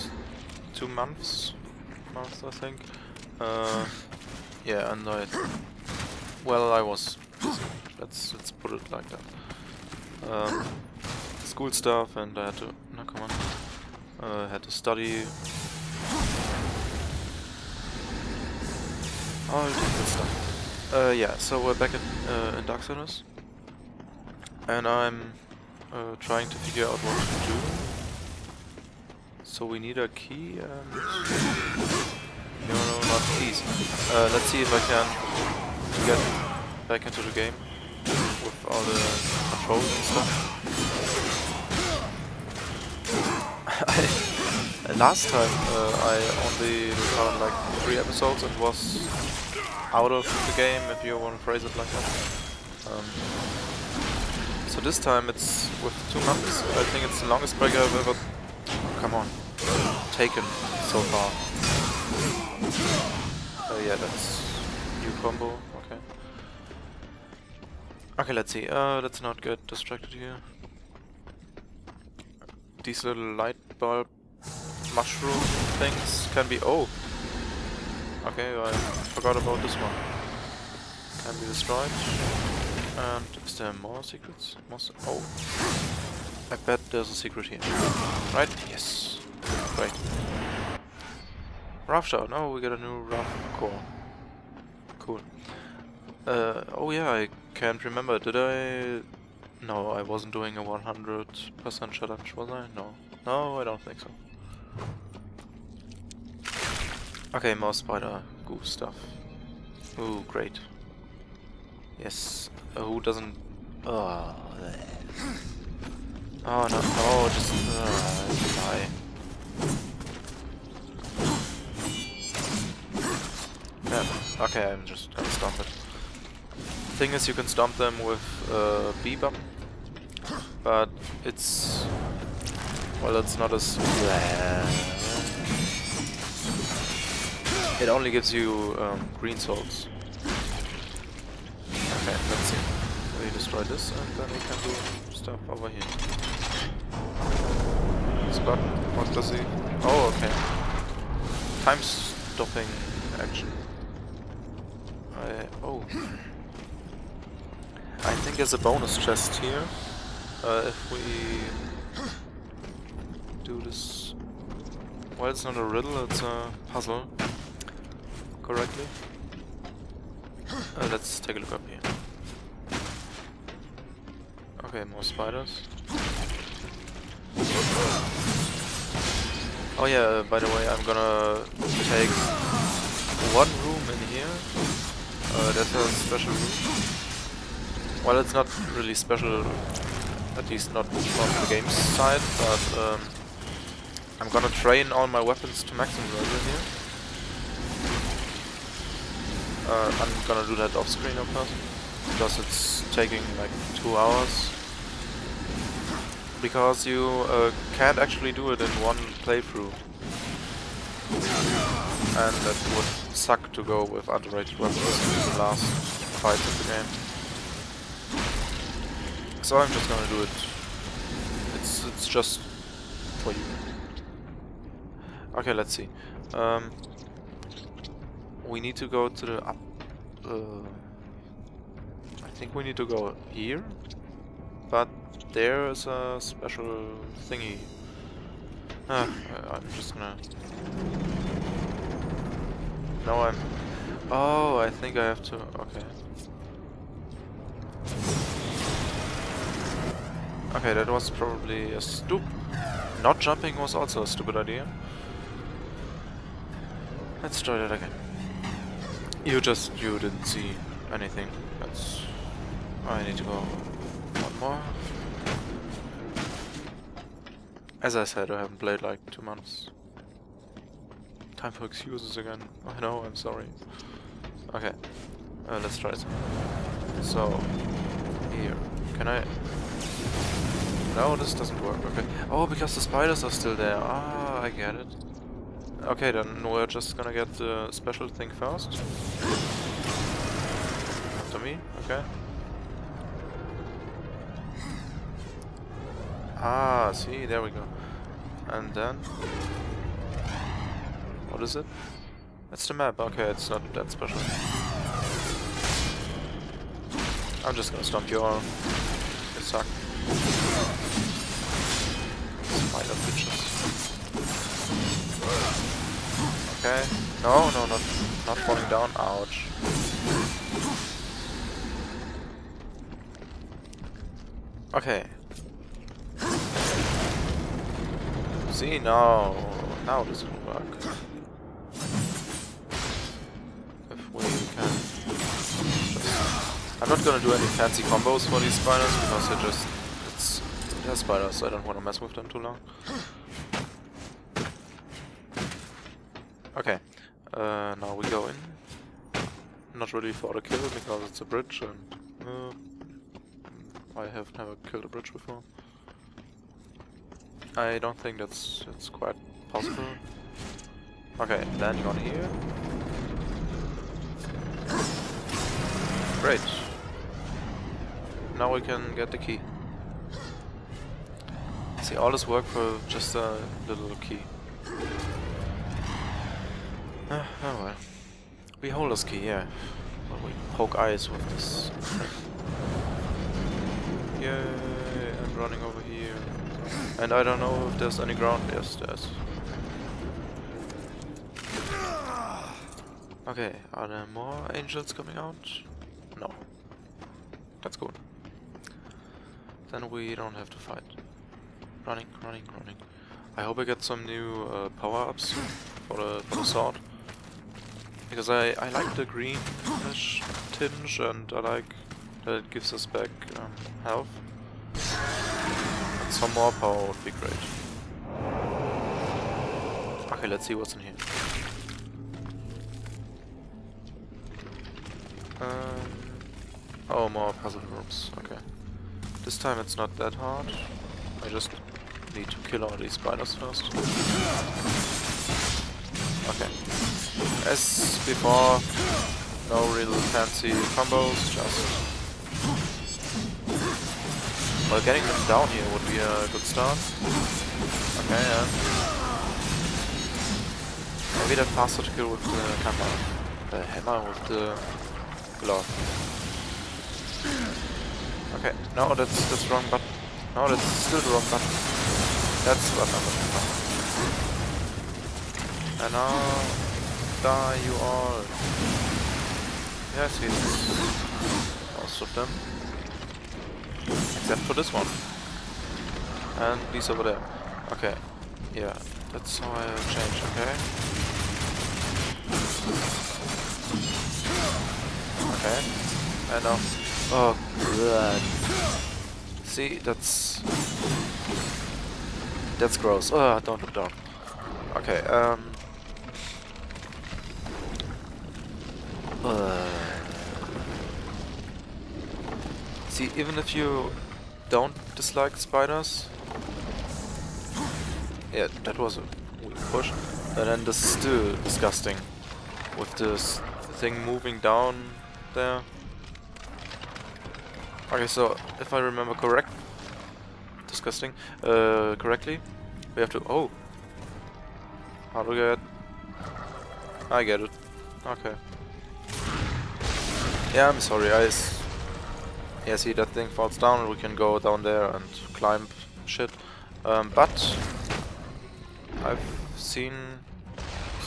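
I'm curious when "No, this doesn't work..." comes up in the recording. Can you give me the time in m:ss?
4:40.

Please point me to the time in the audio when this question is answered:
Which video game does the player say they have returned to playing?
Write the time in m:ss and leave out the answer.
0:22.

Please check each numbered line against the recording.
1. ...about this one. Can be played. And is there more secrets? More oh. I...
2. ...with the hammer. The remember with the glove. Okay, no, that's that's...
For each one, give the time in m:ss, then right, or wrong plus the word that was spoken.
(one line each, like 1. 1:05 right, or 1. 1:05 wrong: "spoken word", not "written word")
1. 1:19 wrong: "destroyed", not "played"
2. 7:32 wrong: "hammer", not "remember".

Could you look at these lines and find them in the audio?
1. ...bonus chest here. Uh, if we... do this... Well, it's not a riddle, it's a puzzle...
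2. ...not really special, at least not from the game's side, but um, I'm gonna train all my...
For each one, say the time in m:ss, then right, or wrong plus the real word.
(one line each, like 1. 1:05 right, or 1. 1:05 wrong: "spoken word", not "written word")
1. 2:38 right
2. 3:08 right.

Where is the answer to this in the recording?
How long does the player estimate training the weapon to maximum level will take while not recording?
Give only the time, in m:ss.
3:23.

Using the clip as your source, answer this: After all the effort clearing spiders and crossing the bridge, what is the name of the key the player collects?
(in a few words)
Beholder's key.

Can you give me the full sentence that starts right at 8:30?
And then this is still disgusting.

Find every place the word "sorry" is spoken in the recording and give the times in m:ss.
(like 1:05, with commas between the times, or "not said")
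4:33, 8:50.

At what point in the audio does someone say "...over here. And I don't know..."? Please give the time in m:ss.
6:25.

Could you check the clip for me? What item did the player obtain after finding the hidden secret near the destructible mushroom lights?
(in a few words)
Wrath Core.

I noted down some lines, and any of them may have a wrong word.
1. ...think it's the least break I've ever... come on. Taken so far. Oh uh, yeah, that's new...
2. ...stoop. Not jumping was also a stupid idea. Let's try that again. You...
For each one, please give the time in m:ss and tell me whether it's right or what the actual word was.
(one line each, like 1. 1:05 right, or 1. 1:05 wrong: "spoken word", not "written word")
1. 0:56 wrong: "longest", not "least"
2. 4:11 right.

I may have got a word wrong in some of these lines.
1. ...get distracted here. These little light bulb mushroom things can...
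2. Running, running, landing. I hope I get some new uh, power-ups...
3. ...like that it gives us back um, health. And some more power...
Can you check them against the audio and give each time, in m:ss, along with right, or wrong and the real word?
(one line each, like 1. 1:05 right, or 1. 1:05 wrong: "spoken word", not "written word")
1. 1:09 right
2. 6:41 wrong: "running", not "landing"
3. 6:51 right.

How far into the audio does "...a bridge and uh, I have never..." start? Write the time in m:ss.
5:51.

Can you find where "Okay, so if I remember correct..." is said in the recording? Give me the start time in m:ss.
8:37.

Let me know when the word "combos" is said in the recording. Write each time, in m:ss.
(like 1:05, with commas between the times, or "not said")
1:05, 5:37, 7:20.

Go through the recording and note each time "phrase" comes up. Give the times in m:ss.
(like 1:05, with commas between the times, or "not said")
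0:51.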